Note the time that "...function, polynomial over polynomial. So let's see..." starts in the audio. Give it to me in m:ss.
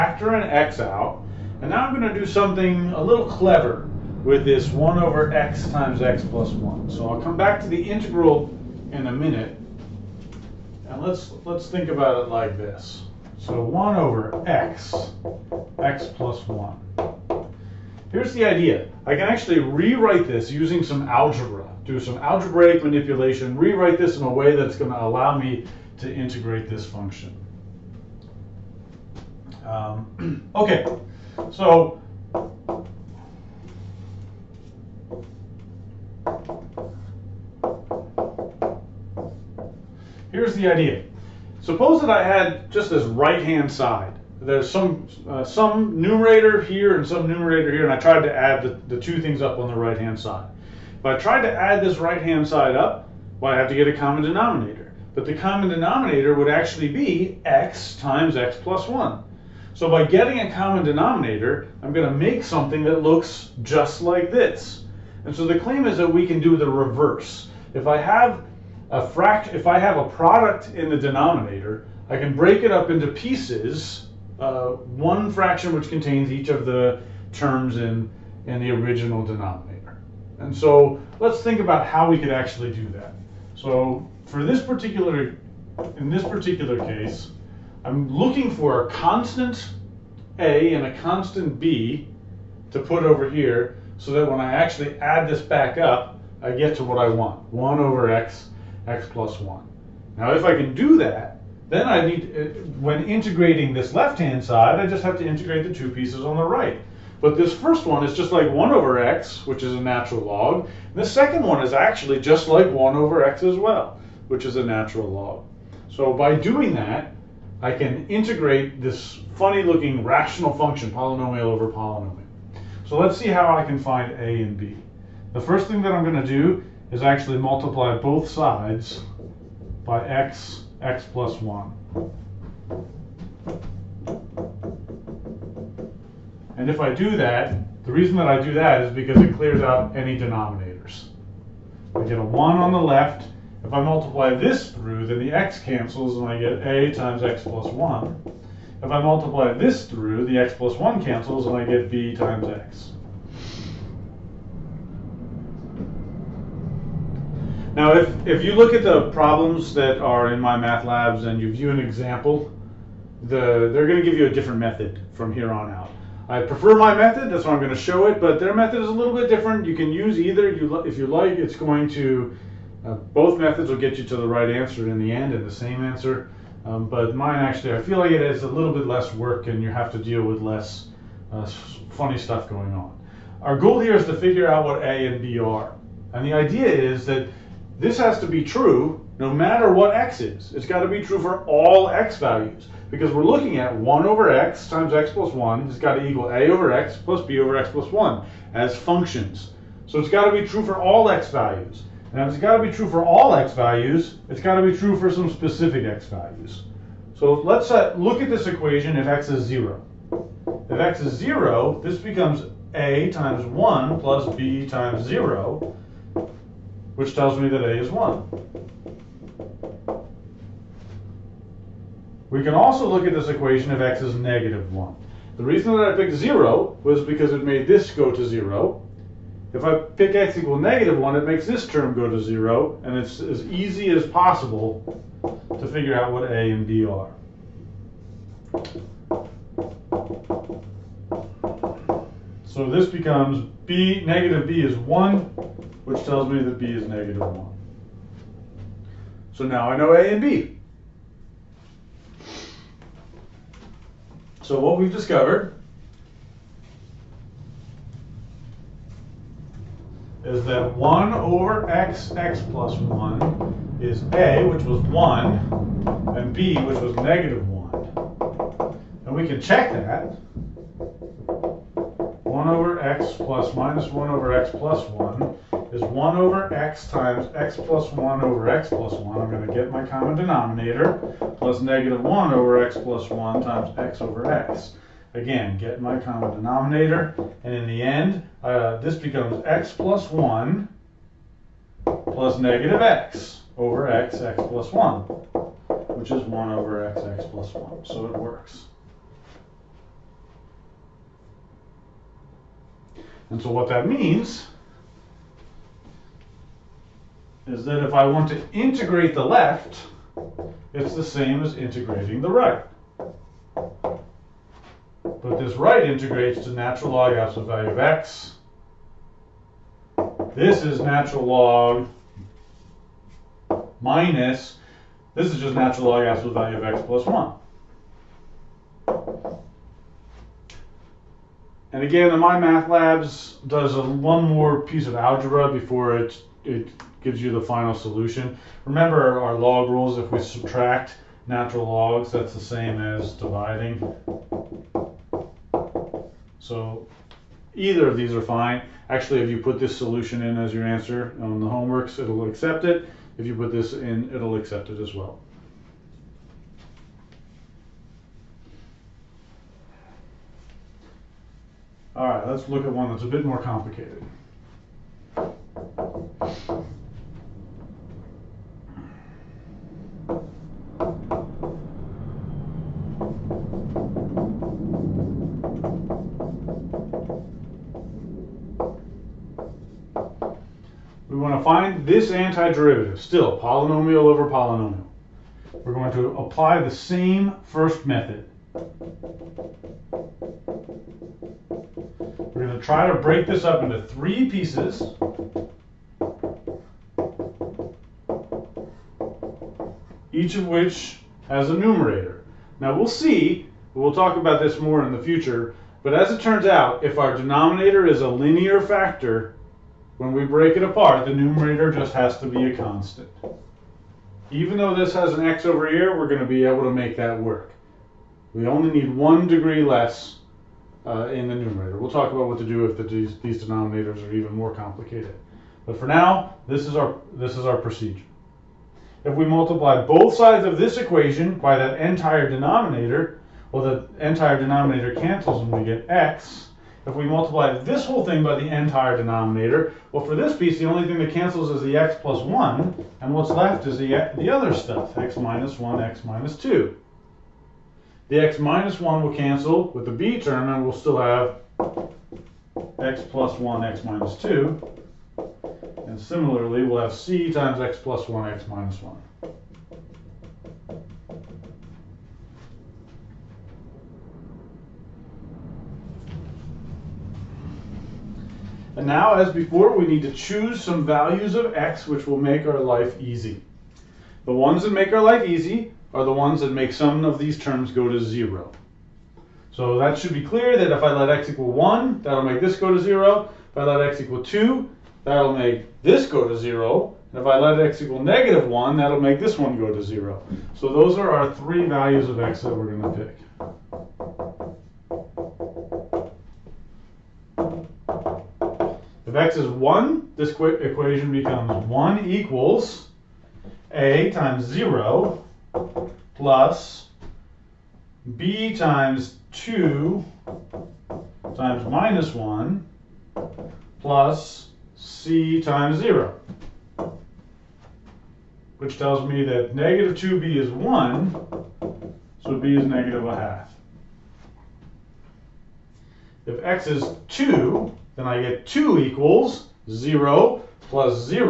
2:00.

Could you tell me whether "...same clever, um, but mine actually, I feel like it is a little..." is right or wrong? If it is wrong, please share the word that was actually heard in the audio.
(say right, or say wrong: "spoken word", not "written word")
wrong: "answer", not "clever".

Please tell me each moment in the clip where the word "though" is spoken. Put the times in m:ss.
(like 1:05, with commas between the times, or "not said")
6:54.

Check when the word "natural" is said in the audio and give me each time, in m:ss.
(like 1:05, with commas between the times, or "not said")
1:49, 1:54, 5:16, 5:20, 5:25, 5:41.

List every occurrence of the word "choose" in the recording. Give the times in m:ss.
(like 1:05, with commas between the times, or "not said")
7:50.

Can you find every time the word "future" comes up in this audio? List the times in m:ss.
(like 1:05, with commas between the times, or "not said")
6:45.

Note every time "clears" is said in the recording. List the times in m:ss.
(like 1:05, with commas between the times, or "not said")
2:19, 8:00.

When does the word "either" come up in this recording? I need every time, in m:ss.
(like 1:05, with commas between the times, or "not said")
2:50, 5:47.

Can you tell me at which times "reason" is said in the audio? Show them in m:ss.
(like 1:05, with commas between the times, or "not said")
2:17, 3:45.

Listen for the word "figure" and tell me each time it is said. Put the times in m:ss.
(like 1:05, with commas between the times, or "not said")
3:04, 3:55.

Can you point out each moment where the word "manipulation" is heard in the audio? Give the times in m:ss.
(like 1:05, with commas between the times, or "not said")
0:22.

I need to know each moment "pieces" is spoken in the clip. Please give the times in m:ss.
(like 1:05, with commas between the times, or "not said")
1:13, 1:45, 5:34, 6:34, 7:20.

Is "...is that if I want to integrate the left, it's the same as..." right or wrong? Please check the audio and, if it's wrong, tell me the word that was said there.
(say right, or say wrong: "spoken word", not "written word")
right.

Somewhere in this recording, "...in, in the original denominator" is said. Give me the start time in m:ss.
1:17.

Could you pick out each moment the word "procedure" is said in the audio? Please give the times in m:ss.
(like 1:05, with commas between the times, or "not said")
7:07.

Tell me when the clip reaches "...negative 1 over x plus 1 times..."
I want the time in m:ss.
4:41.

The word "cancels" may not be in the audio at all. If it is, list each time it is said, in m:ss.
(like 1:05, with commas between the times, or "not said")
2:25, 2:31, 7:14, 7:21, 7:29.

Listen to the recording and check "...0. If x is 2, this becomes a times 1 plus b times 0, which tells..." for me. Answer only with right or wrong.
wrong.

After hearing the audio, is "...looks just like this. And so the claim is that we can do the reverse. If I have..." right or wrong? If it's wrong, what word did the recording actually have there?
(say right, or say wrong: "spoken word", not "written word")
right.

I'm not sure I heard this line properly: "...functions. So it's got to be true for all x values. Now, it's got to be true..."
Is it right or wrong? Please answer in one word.
right.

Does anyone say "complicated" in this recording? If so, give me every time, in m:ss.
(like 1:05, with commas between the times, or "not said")
6:03, 7:04.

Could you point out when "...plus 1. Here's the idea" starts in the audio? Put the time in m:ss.
0:16.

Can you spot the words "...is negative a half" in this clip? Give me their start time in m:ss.
8:42.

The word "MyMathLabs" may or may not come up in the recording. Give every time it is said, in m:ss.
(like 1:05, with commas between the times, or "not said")
2:40, 5:32.